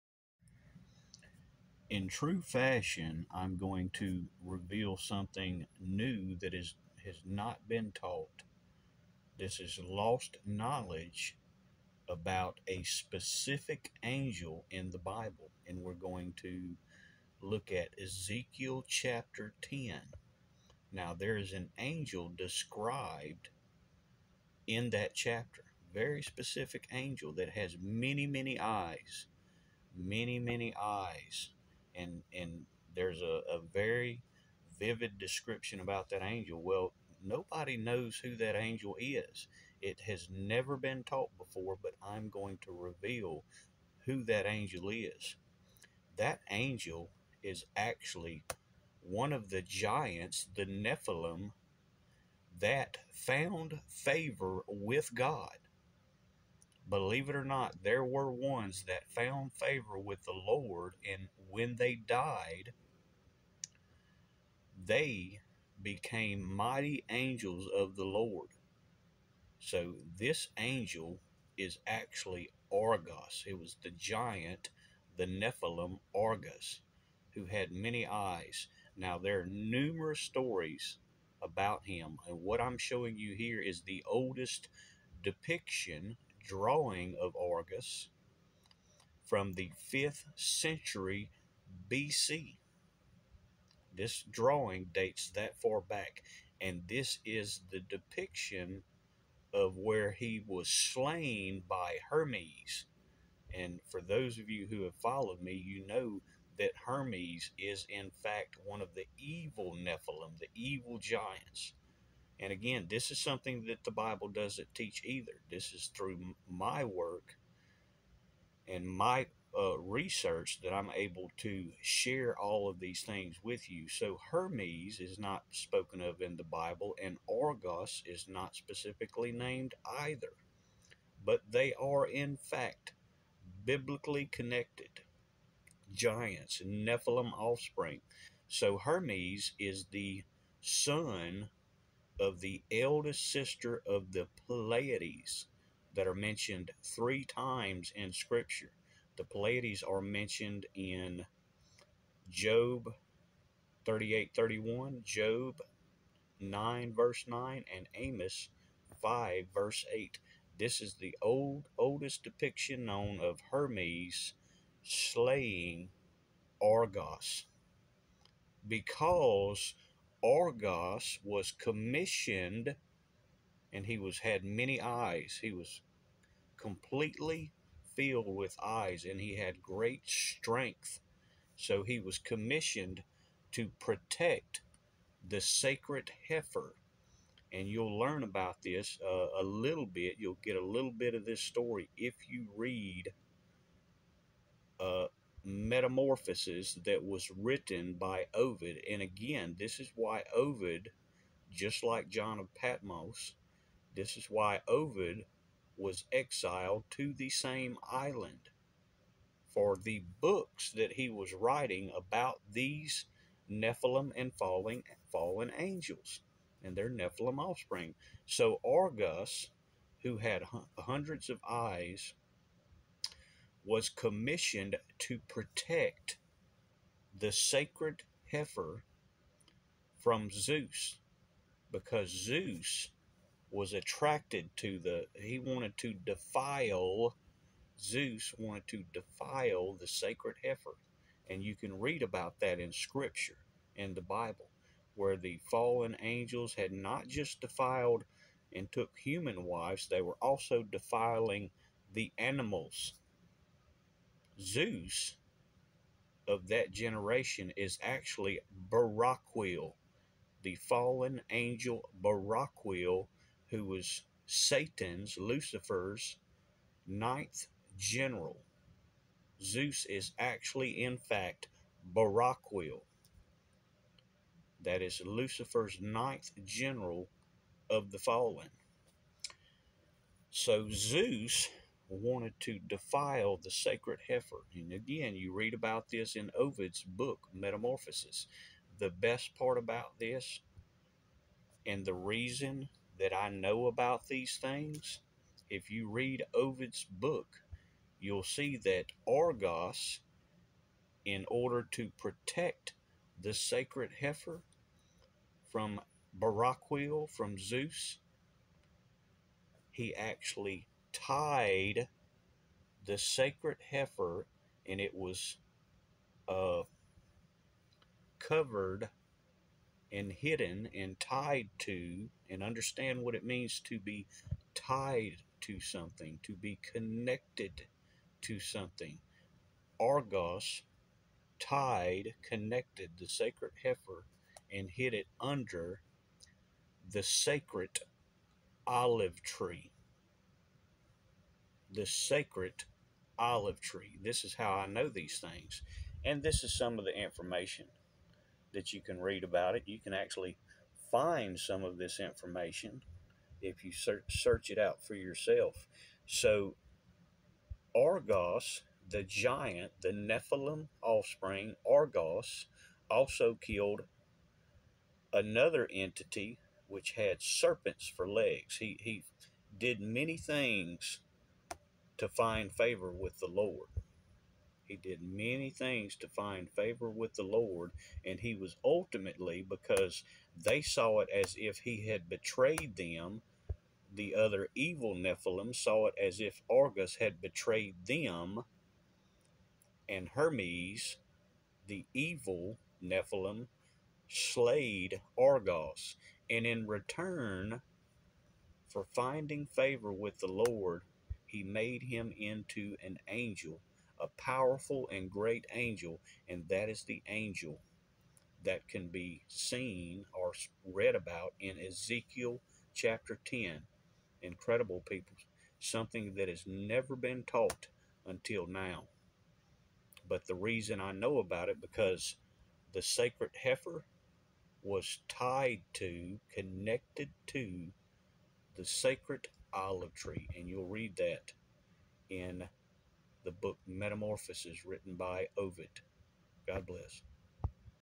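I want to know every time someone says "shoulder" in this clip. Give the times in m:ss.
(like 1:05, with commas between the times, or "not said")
not said.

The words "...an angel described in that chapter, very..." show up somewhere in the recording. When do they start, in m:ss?
0:21.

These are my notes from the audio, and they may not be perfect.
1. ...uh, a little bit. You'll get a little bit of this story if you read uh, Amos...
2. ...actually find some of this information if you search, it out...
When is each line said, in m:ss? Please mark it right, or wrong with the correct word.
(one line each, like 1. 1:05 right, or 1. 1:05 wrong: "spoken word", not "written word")
1. 3:09 wrong: "Metamorphoses", not "Amos"
2. 5:49 right.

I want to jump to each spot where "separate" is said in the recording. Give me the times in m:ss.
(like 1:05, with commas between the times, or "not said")
not said.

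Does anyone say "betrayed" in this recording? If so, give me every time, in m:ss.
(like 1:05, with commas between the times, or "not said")
6:22, 6:27.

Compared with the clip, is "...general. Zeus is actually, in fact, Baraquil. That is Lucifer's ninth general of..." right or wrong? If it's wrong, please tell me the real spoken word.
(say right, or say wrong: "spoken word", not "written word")
right.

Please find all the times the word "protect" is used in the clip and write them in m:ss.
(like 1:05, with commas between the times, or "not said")
3:03, 3:45, 5:01.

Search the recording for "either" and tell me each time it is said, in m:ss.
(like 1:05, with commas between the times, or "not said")
1:55, 2:09.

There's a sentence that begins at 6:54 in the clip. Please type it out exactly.
Incredible people, something that has never been taught until now.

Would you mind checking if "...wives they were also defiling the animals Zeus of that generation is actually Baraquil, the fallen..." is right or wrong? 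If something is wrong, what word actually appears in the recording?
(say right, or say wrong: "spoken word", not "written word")
right.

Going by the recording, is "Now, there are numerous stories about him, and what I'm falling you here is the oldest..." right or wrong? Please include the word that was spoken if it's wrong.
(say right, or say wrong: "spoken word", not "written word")
wrong: "showing", not "falling".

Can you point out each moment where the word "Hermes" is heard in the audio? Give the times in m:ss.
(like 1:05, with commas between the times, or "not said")
1:42, 1:46, 2:04, 2:18, 2:43, 6:30.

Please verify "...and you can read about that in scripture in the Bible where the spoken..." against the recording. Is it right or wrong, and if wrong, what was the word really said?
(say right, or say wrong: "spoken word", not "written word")
wrong: "fallen", not "spoken".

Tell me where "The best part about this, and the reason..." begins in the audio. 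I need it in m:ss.
4:48.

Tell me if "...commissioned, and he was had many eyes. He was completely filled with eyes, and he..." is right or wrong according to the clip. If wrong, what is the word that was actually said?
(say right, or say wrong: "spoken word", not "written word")
right.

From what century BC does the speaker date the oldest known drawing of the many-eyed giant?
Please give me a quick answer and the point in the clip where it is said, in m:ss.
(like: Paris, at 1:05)
5th century BC, at 1:29.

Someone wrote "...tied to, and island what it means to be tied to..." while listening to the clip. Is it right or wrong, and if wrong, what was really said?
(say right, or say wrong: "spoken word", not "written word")
wrong: "understand", not "island".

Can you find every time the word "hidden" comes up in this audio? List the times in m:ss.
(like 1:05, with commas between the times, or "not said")
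5:20.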